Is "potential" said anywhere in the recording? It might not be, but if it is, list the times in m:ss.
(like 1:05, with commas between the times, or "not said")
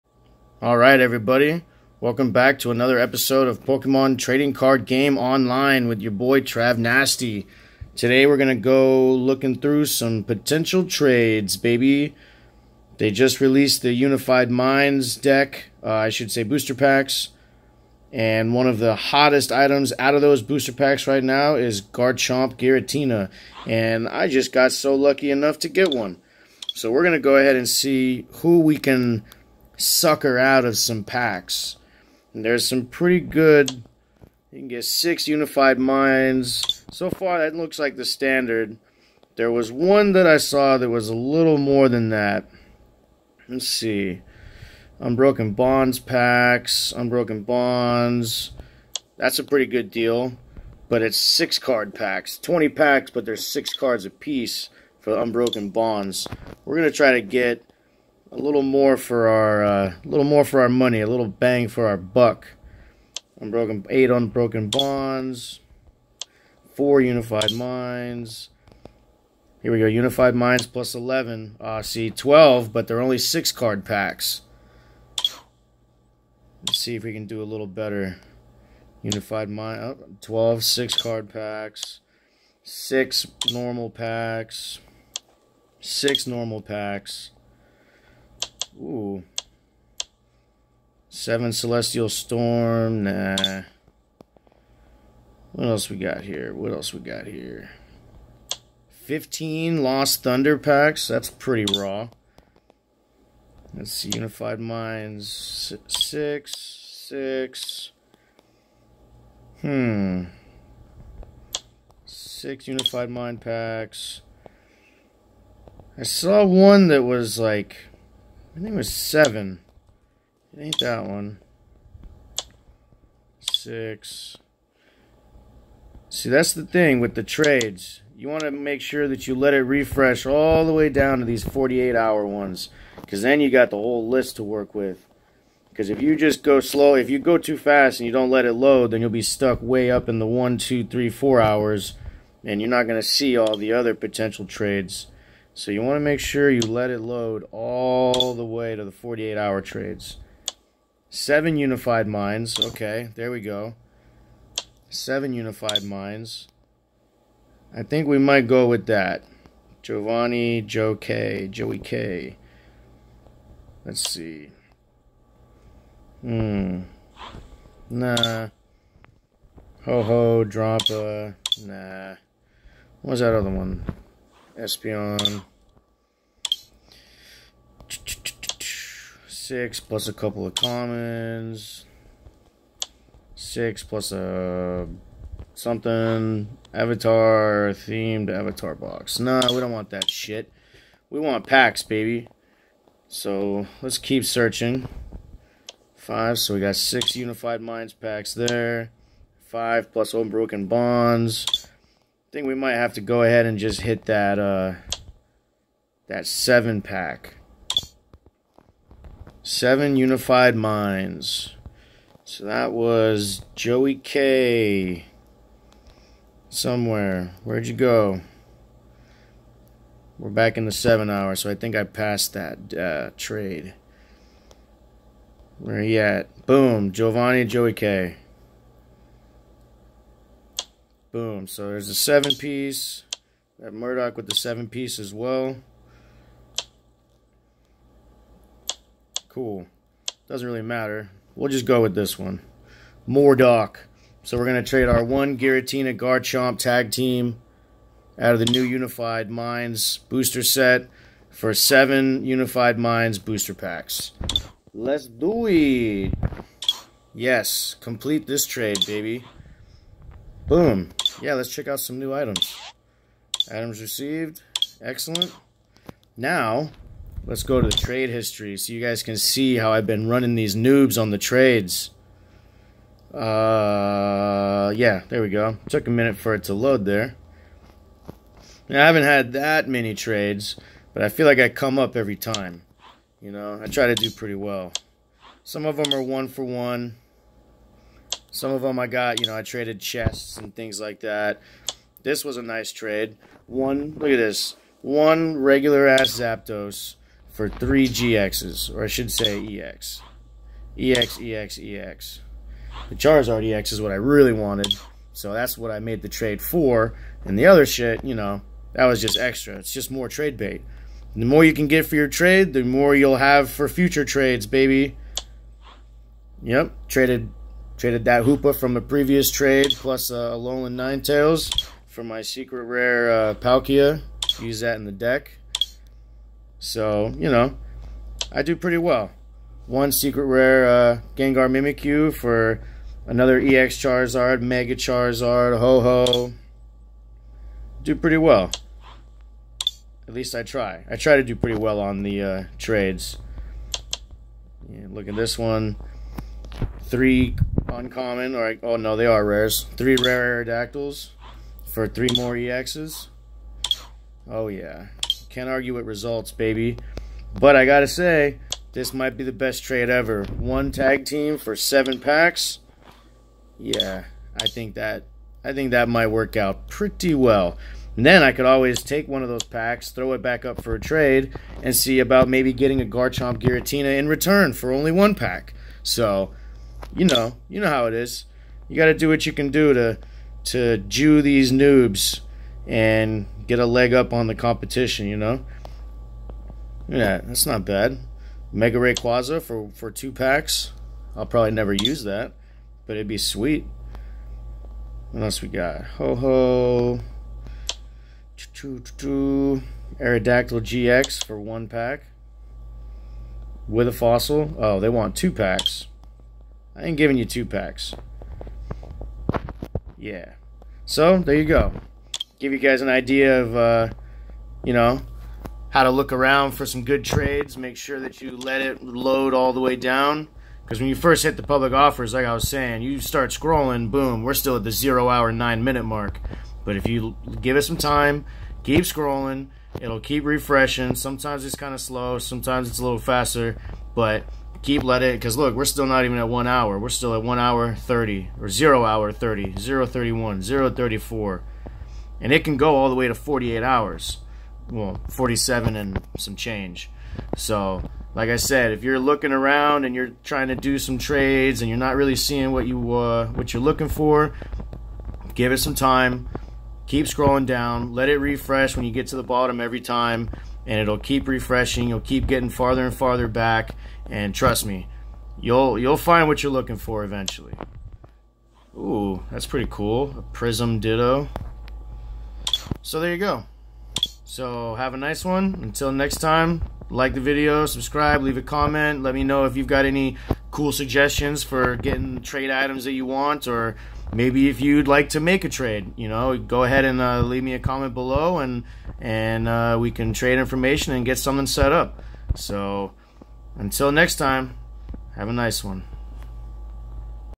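0:10, 2:23.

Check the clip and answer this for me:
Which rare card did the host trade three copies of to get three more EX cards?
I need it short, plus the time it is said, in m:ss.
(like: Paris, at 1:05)
Aerodactyl, at 5:50.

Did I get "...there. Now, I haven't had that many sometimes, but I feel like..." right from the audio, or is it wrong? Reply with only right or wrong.
wrong.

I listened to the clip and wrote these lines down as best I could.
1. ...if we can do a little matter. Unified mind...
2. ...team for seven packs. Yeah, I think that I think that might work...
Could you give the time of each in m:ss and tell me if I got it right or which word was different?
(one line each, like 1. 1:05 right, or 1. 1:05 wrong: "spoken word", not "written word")
1. 1:16 wrong: "better", not "matter"
2. 6:01 right.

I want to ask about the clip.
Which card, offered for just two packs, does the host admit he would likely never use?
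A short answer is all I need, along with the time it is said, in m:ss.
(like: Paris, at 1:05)
Mega Rayquaza, at 6:28.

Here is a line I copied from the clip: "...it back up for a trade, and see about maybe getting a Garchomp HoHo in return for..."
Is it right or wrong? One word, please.
wrong.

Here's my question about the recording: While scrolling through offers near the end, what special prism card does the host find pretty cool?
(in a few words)
Ditto.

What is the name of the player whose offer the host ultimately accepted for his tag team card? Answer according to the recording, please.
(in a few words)
Murdock.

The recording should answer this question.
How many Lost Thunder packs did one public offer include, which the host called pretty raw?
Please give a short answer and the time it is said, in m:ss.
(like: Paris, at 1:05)
15, at 1:39.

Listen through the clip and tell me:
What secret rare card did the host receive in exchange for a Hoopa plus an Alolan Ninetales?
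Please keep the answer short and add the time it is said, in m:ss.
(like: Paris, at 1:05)
Palkia, at 5:23.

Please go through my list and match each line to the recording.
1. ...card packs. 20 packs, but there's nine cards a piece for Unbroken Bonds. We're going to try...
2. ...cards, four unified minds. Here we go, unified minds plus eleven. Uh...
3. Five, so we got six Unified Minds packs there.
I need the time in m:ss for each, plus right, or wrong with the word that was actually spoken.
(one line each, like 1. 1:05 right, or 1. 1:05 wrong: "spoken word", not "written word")
1. 0:51 wrong: "six", not "nine"
2. 1:04 wrong: "bonds", not "cards"
3. 3:15 right.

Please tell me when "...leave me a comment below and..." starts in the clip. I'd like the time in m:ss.
8:07.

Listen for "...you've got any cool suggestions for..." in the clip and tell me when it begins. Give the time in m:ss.
7:59.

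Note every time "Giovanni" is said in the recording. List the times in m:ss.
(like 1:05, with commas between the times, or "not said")
2:39, 3:46.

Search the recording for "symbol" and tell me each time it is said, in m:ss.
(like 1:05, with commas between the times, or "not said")
not said.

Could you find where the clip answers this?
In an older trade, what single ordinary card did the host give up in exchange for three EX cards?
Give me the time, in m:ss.
4:56.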